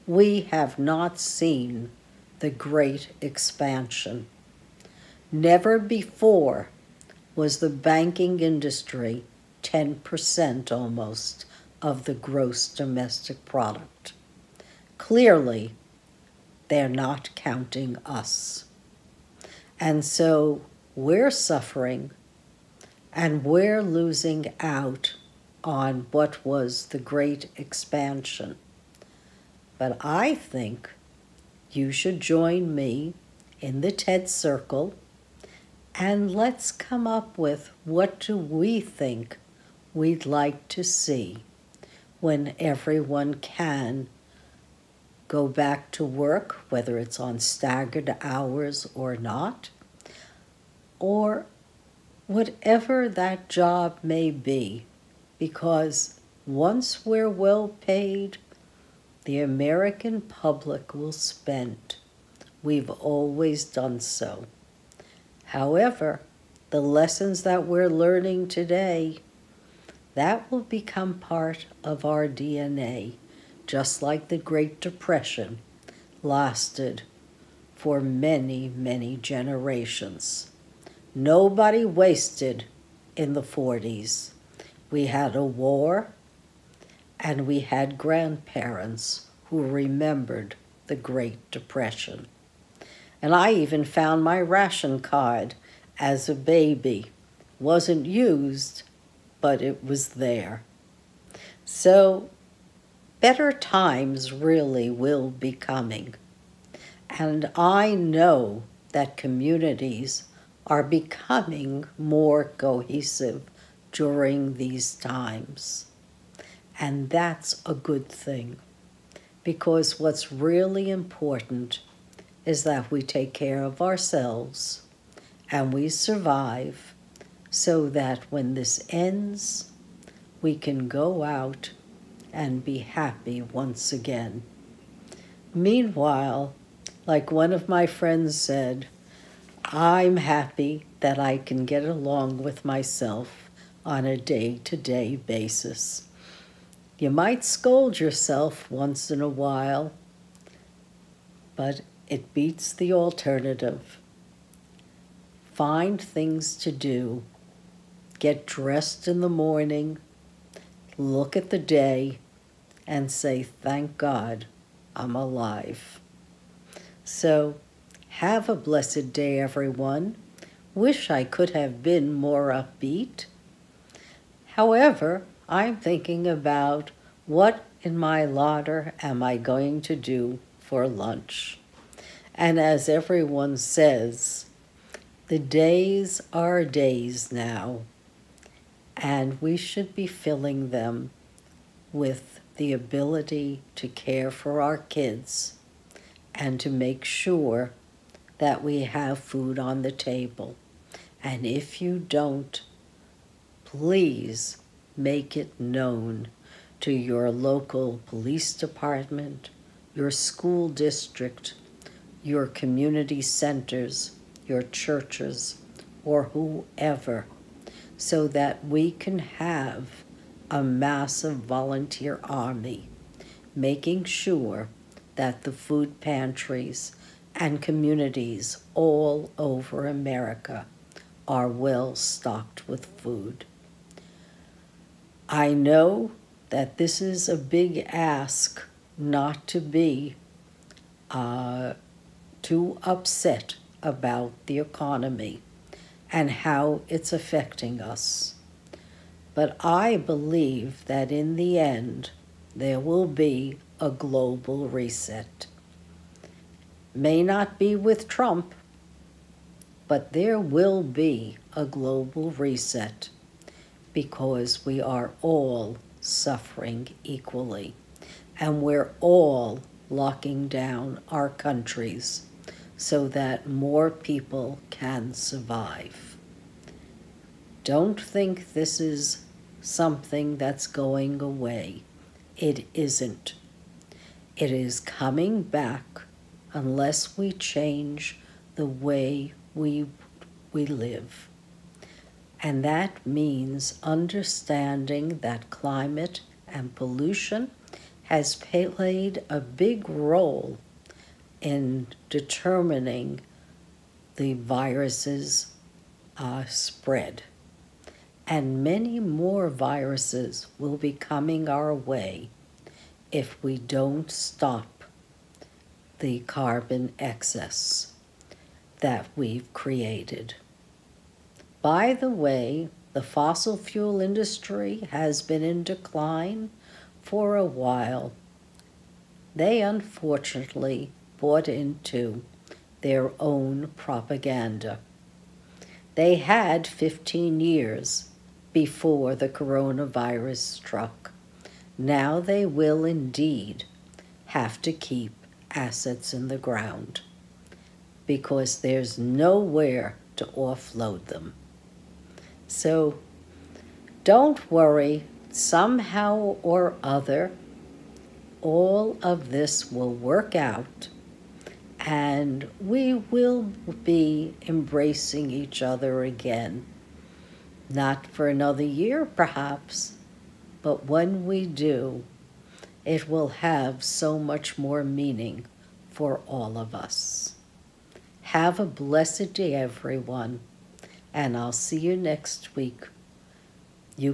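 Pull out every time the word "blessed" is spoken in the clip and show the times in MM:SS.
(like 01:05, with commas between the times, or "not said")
02:48, 06:18.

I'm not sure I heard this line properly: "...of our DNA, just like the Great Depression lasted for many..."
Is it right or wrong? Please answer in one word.
right.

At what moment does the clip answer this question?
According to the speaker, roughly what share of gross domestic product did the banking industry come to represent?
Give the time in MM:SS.
00:09.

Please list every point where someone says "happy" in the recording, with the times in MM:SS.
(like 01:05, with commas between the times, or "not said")
02:12, 02:20.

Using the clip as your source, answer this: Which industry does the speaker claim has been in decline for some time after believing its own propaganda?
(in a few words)
fossil fuel industry.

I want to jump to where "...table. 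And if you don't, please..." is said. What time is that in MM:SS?
03:19.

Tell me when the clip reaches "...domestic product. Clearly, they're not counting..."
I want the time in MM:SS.
00:12.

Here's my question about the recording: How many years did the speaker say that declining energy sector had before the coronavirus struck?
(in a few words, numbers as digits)
15.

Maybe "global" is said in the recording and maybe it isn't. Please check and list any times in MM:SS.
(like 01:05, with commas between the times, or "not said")
04:13, 04:21.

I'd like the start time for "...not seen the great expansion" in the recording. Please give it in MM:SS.
00:00.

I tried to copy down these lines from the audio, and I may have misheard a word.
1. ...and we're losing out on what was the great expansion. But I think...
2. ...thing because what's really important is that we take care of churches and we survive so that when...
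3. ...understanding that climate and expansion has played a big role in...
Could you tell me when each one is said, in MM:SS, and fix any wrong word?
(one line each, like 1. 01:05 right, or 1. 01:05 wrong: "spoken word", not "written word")
1. 00:23 right
2. 01:58 wrong: "ourselves", not "churches"
3. 04:53 wrong: "pollution", not "expansion".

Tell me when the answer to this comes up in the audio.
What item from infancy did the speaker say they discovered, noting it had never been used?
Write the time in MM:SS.
01:34.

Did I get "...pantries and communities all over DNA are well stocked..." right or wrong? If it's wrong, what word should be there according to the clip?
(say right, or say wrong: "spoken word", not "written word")
wrong: "America", not "DNA".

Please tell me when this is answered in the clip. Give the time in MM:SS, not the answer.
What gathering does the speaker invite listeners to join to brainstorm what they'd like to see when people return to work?
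00:33.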